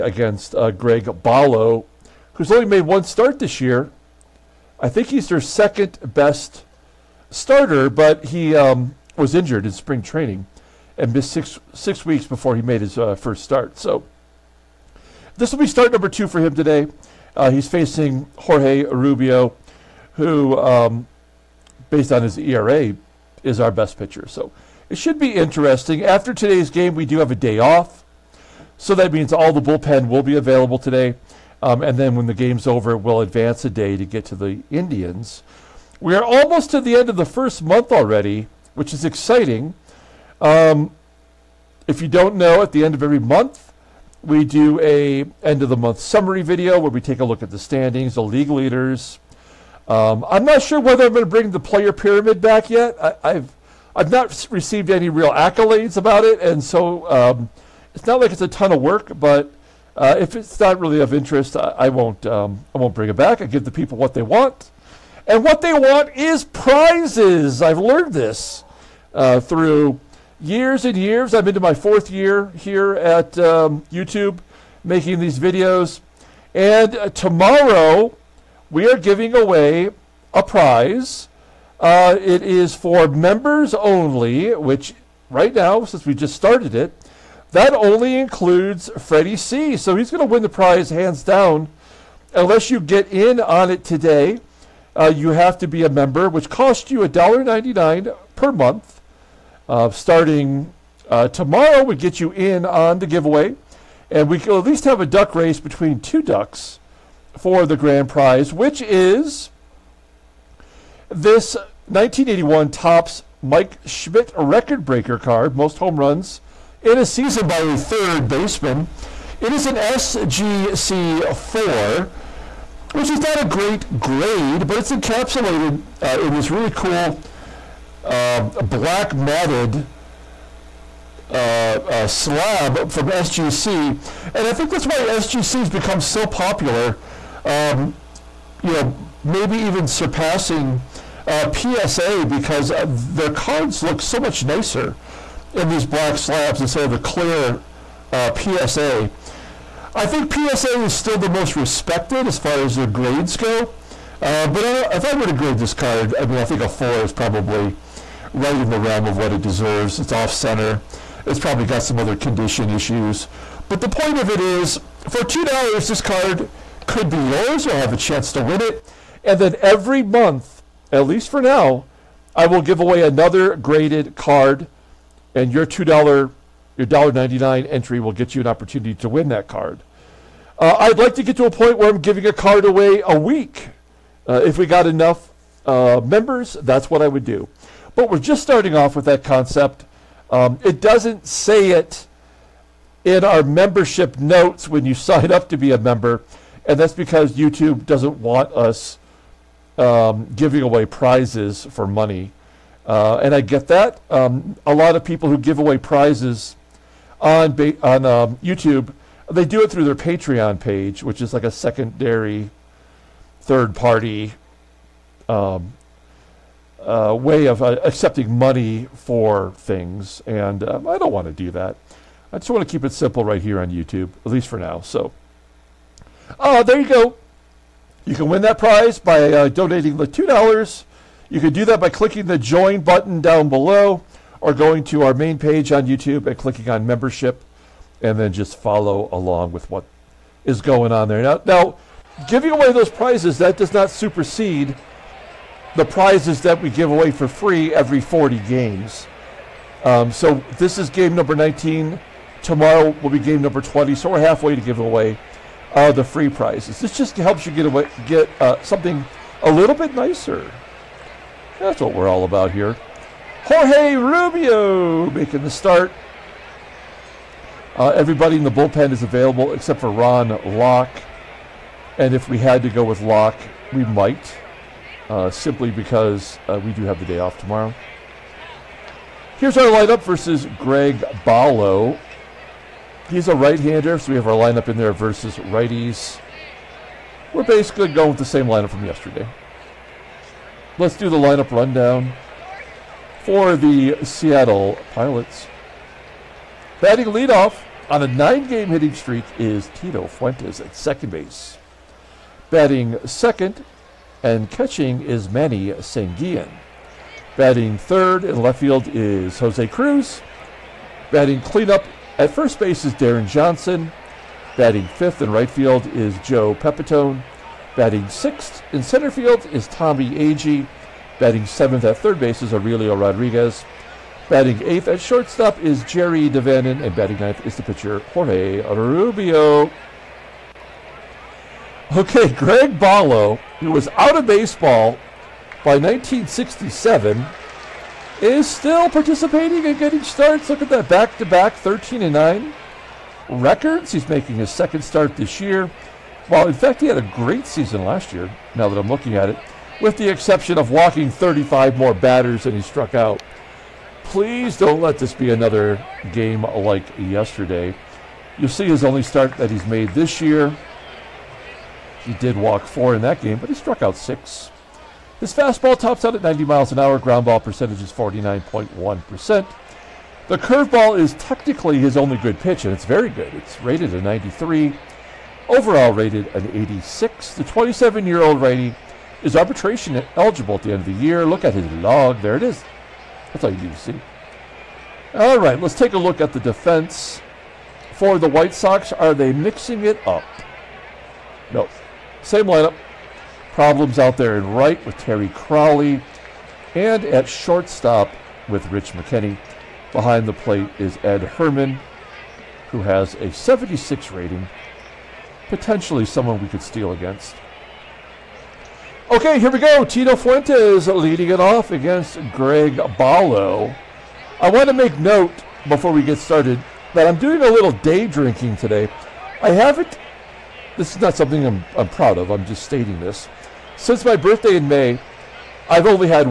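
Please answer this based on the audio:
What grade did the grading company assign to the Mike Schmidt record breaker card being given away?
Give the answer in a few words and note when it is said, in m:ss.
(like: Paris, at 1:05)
4, at 2:01.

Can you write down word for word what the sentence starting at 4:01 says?
Now, now giving away those prizes, that does not supersede the prizes that we give away for free every 40 games.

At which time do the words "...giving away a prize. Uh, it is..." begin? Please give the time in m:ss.
1:18.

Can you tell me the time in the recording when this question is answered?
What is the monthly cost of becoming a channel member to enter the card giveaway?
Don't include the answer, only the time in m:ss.
1:37.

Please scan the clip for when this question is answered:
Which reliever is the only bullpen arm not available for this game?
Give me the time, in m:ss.
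4:29.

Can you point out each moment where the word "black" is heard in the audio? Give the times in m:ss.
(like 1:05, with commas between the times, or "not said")
2:08, 2:25.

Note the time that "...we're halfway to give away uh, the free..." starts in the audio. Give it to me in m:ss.
4:14.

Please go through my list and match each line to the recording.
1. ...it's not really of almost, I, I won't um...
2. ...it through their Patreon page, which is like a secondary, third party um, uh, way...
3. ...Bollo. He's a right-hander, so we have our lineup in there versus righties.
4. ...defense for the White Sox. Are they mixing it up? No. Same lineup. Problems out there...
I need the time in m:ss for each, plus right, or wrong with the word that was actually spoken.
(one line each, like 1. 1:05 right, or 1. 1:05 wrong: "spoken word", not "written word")
1. 1:00 wrong: "interest", not "almost"
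2. 3:29 right
3. 4:41 right
4. 6:26 right.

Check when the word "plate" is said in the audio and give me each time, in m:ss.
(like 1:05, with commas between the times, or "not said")
6:40.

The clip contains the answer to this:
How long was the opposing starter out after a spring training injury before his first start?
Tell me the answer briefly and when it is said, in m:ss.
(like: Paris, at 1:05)
6 weeks, at 0:11.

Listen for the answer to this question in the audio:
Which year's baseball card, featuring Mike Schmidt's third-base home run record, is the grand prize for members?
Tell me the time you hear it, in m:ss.
1:51.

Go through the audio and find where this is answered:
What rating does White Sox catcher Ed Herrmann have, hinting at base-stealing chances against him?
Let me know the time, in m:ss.
6:43.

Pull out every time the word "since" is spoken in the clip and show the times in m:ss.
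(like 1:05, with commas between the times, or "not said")
1:25, 7:03.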